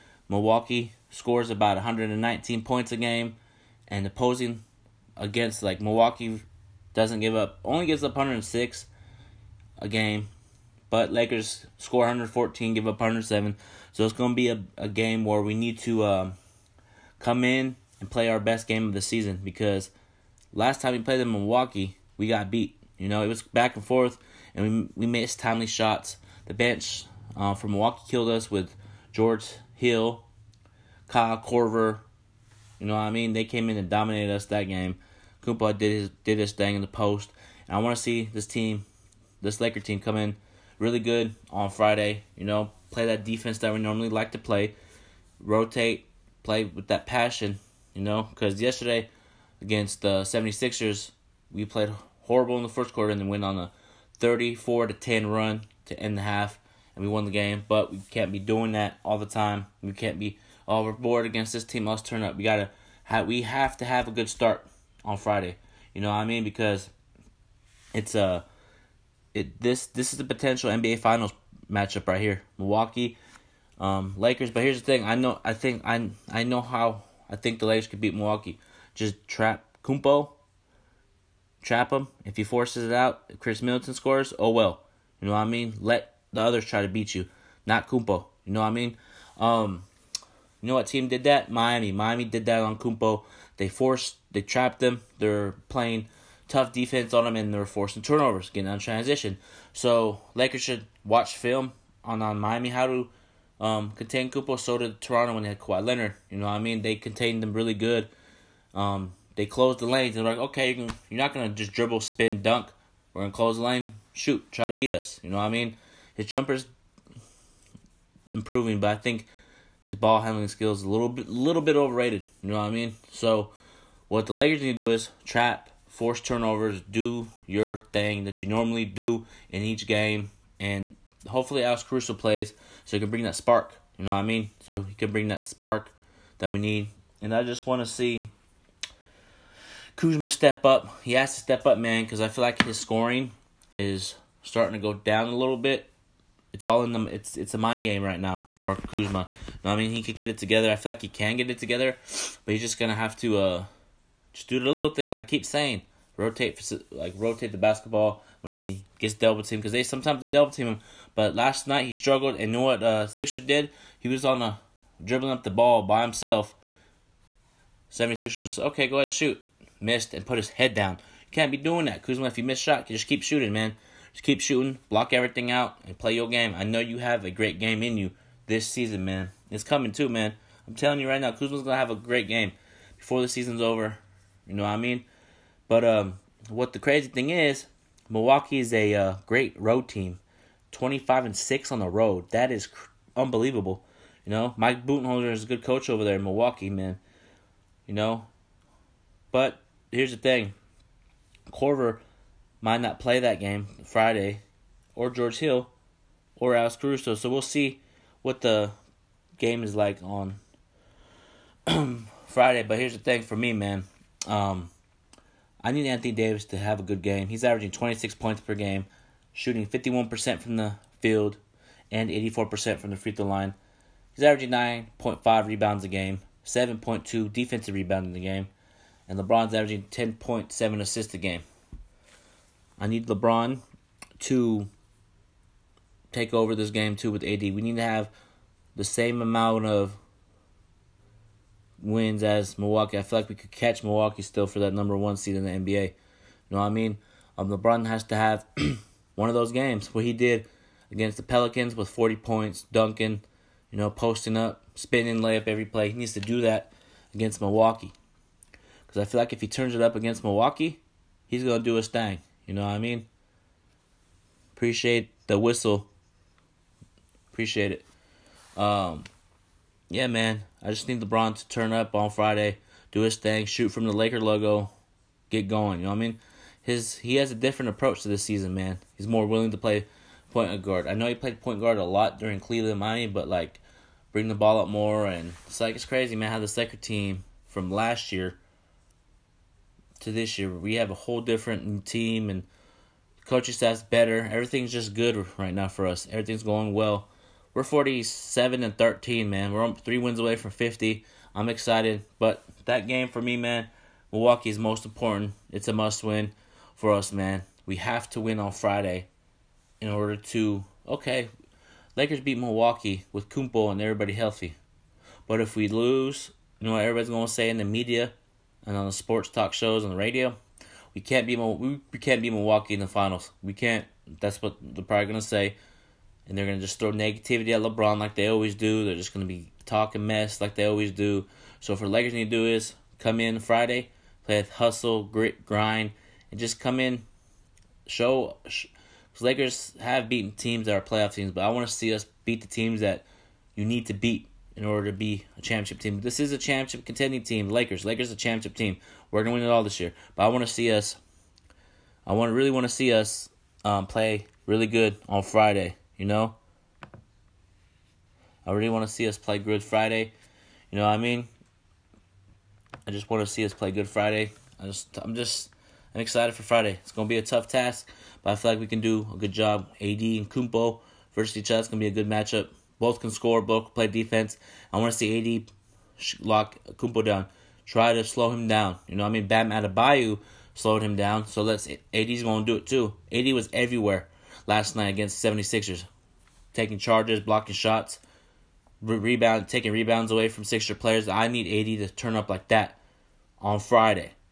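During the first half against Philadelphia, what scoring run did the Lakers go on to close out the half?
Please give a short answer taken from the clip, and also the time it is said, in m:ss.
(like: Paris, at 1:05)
34 to 10, at 0:54.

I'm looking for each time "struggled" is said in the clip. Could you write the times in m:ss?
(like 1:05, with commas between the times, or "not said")
2:41.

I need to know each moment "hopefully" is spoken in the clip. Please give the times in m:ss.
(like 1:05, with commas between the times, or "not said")
2:11.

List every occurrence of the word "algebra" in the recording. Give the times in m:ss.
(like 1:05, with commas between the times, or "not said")
not said.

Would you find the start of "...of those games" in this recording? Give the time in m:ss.
4:09.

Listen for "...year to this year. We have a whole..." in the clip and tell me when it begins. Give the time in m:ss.
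4:48.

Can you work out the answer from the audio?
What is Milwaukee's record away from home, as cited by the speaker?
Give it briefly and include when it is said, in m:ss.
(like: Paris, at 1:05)
25 and 6, at 3:10.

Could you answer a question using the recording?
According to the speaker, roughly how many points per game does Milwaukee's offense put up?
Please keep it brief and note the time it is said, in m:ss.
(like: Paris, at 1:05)
119, at 0:01.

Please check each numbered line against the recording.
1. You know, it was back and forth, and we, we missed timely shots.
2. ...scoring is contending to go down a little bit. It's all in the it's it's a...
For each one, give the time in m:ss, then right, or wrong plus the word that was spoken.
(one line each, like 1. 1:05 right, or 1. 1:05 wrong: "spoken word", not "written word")
1. 0:22 right
2. 2:22 wrong: "starting", not "contending".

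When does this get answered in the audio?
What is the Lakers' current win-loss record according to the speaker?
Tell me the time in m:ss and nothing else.
4:57.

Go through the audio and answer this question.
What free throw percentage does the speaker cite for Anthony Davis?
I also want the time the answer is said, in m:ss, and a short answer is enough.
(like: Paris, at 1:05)
84%, at 3:42.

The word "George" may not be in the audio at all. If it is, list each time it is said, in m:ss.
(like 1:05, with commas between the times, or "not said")
0:29, 3:25.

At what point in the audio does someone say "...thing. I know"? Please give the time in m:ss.
1:14.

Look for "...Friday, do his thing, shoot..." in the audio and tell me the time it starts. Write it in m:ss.
4:32.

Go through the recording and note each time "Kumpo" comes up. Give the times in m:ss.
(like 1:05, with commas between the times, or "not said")
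1:19, 1:27, 1:32, 1:44, 5:13, 6:10, 6:16.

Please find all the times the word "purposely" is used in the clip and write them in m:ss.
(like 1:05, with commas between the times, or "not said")
not said.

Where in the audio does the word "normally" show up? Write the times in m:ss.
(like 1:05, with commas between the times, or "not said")
0:43, 2:08.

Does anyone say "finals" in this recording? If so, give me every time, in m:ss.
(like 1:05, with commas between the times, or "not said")
1:10, 5:22.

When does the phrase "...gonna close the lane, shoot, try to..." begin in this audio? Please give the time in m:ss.
1:53.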